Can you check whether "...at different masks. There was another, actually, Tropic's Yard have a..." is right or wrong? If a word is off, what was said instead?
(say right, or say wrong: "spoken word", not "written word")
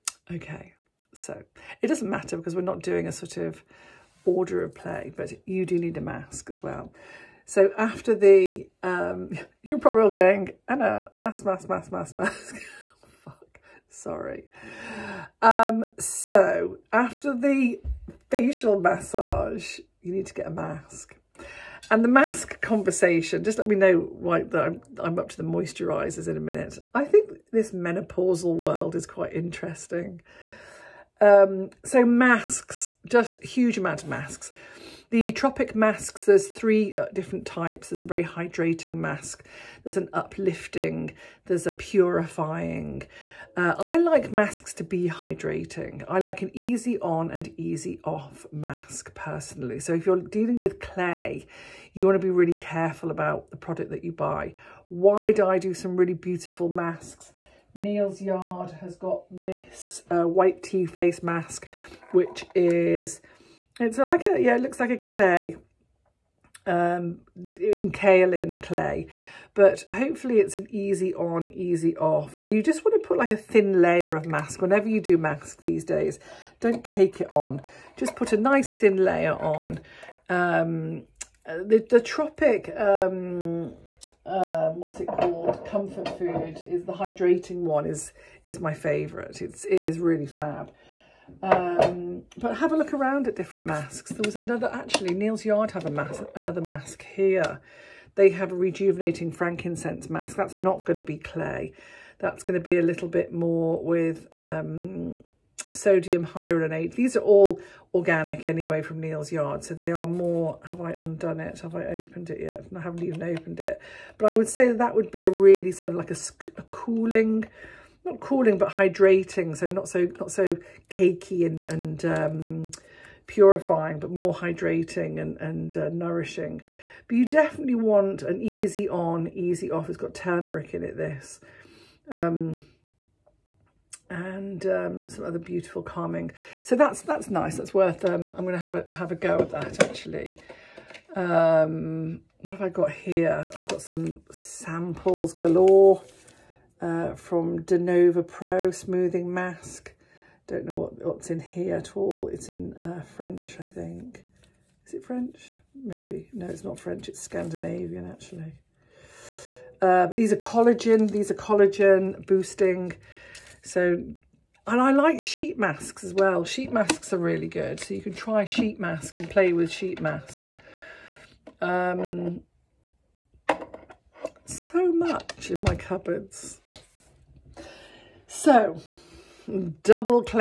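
wrong: "Neal", not "Tropic".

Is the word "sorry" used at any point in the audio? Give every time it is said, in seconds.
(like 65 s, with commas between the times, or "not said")
13 s.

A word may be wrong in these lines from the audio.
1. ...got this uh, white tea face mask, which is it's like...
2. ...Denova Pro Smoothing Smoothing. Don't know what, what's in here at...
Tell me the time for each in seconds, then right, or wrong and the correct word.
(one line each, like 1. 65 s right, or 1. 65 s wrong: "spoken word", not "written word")
1. 58 s right
2. 147 s wrong: "Mask", not "Smoothing".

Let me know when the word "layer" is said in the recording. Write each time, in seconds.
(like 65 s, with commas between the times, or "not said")
73 s, 78 s.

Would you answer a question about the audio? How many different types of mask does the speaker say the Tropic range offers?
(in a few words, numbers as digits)
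3.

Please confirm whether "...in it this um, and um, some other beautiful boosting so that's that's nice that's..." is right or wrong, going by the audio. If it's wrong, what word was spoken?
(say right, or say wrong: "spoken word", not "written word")
wrong: "calming", not "boosting".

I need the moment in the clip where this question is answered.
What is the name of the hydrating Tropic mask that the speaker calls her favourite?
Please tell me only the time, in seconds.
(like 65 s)
85 s.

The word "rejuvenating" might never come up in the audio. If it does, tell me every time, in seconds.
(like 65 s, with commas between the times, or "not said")
98 s.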